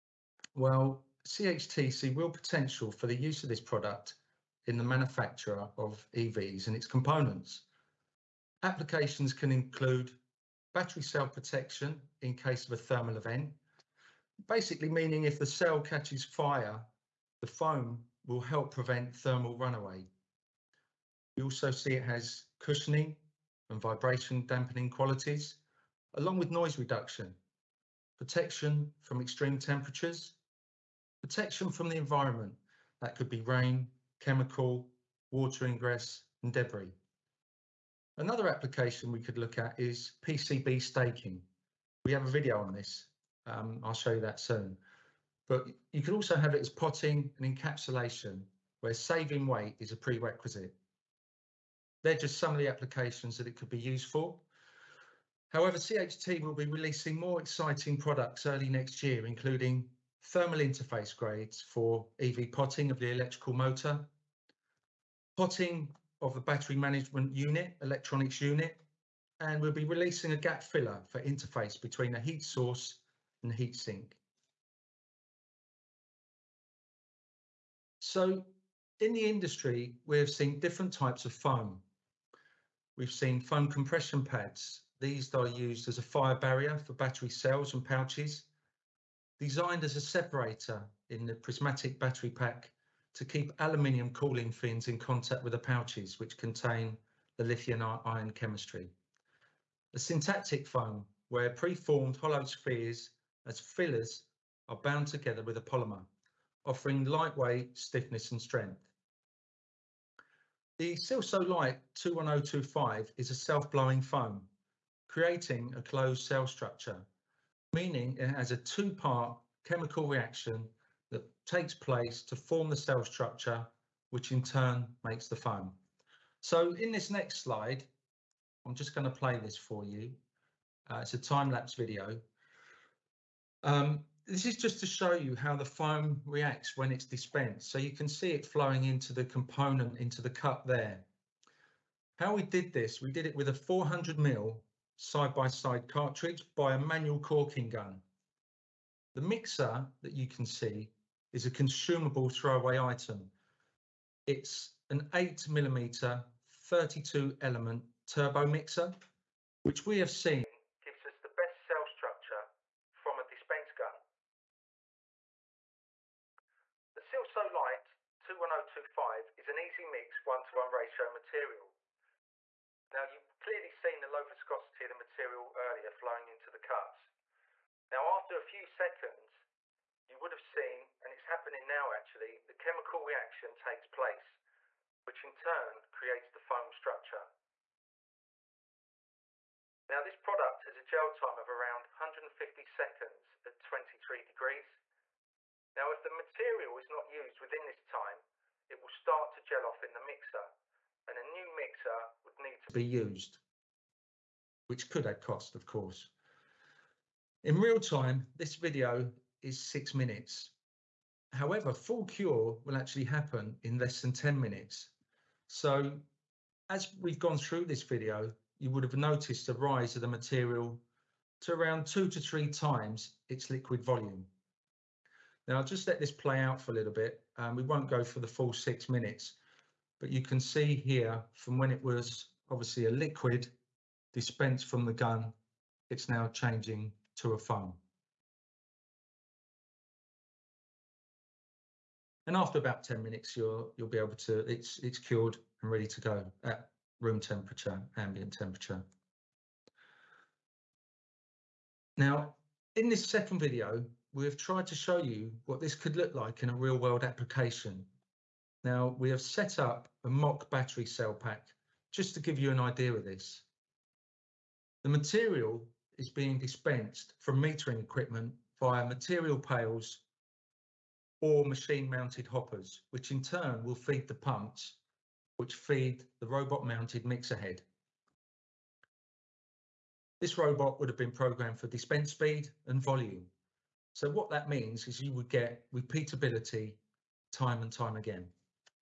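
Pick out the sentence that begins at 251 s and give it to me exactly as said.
Now, in this second video, we have tried to show you what this could look like in a real world application.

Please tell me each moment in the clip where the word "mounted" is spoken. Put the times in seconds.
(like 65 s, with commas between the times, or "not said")
271 s, 276 s.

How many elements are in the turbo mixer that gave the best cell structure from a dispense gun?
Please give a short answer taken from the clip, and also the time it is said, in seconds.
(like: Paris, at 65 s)
32, at 156 s.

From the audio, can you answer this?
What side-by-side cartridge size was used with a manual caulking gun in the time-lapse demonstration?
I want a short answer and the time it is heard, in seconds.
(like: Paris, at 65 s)
400 mil, at 143 s.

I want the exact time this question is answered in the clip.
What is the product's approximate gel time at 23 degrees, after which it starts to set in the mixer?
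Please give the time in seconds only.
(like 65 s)
191 s.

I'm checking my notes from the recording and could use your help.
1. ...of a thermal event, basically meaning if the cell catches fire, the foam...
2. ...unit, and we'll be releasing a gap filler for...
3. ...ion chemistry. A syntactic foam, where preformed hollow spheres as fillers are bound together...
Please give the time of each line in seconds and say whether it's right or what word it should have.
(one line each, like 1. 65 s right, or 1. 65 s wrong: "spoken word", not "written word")
1. 12 s right
2. 68 s right
3. 97 s right.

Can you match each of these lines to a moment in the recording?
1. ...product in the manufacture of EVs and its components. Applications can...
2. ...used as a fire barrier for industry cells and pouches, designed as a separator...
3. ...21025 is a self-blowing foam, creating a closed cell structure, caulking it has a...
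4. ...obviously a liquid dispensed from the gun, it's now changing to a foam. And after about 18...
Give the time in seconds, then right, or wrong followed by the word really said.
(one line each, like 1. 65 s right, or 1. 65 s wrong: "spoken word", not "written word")
1. 3 s right
2. 85 s wrong: "battery", not "industry"
3. 111 s wrong: "meaning", not "caulking"
4. 232 s wrong: "10", not "18".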